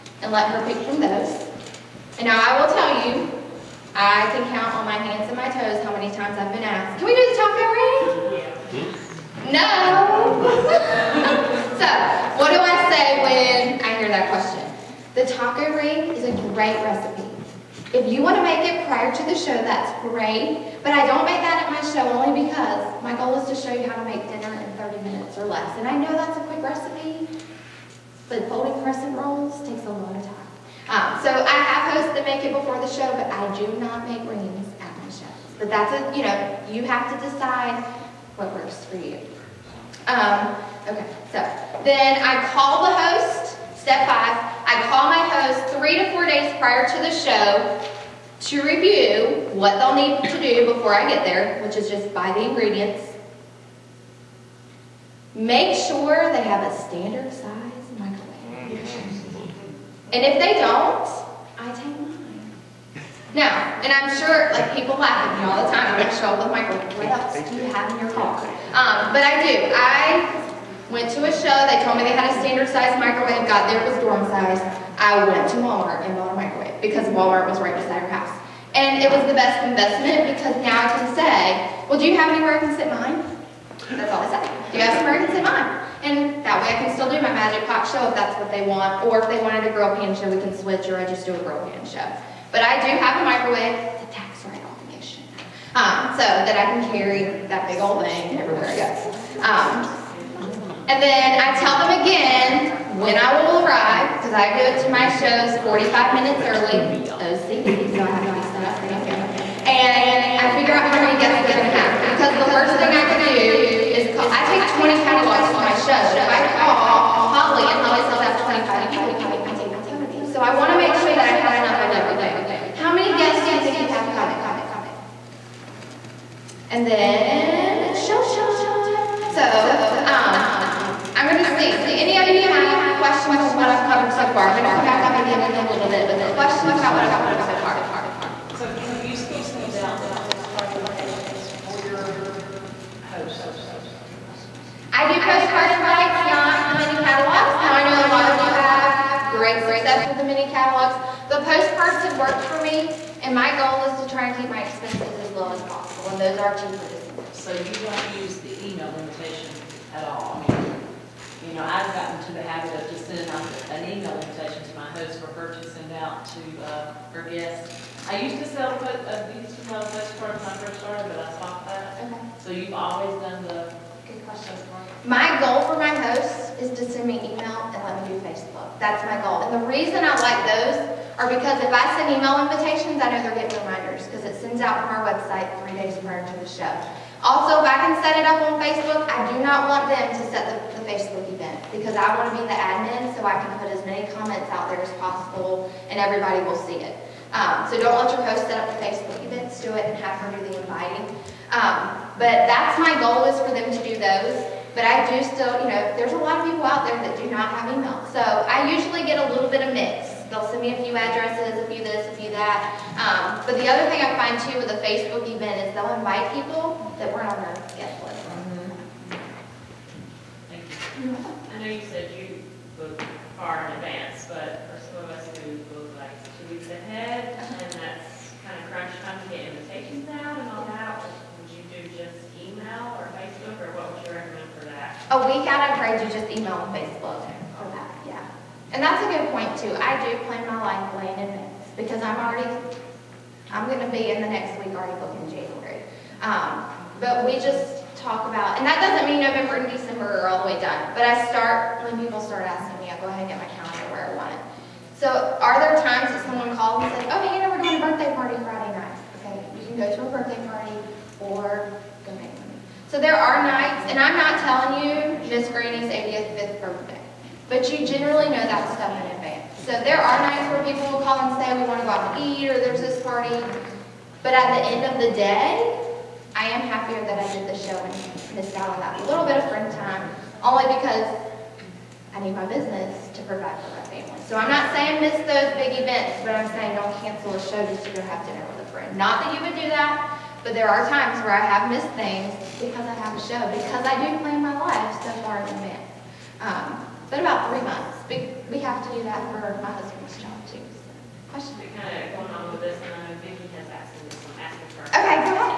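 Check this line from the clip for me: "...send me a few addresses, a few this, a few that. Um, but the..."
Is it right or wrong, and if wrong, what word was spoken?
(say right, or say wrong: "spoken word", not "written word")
right.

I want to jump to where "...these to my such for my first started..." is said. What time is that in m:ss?
2:49.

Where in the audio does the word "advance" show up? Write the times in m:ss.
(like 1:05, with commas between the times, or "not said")
3:43, 4:01, 4:29, 4:55.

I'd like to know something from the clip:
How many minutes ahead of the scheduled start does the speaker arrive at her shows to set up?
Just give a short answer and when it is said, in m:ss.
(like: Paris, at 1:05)
45, at 1:45.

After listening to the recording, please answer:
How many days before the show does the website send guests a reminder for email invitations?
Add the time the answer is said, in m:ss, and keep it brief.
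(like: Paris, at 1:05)
3, at 3:05.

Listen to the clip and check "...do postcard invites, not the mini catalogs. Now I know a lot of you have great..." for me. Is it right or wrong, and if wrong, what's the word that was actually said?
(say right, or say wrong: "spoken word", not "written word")
right.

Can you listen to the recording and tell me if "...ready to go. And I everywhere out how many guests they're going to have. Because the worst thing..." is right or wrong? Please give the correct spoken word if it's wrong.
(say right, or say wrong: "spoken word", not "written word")
wrong: "figure", not "everywhere".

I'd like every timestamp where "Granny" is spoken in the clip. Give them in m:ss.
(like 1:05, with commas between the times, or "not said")
4:25.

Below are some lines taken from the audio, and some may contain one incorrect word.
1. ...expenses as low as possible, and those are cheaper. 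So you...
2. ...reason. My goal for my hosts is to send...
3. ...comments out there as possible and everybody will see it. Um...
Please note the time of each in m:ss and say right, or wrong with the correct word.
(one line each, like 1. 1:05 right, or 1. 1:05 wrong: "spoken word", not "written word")
1. 2:34 right
2. 2:54 wrong: "question", not "reason"
3. 3:14 right.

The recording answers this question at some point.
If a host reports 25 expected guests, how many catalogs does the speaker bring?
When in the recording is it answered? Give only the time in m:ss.
1:59.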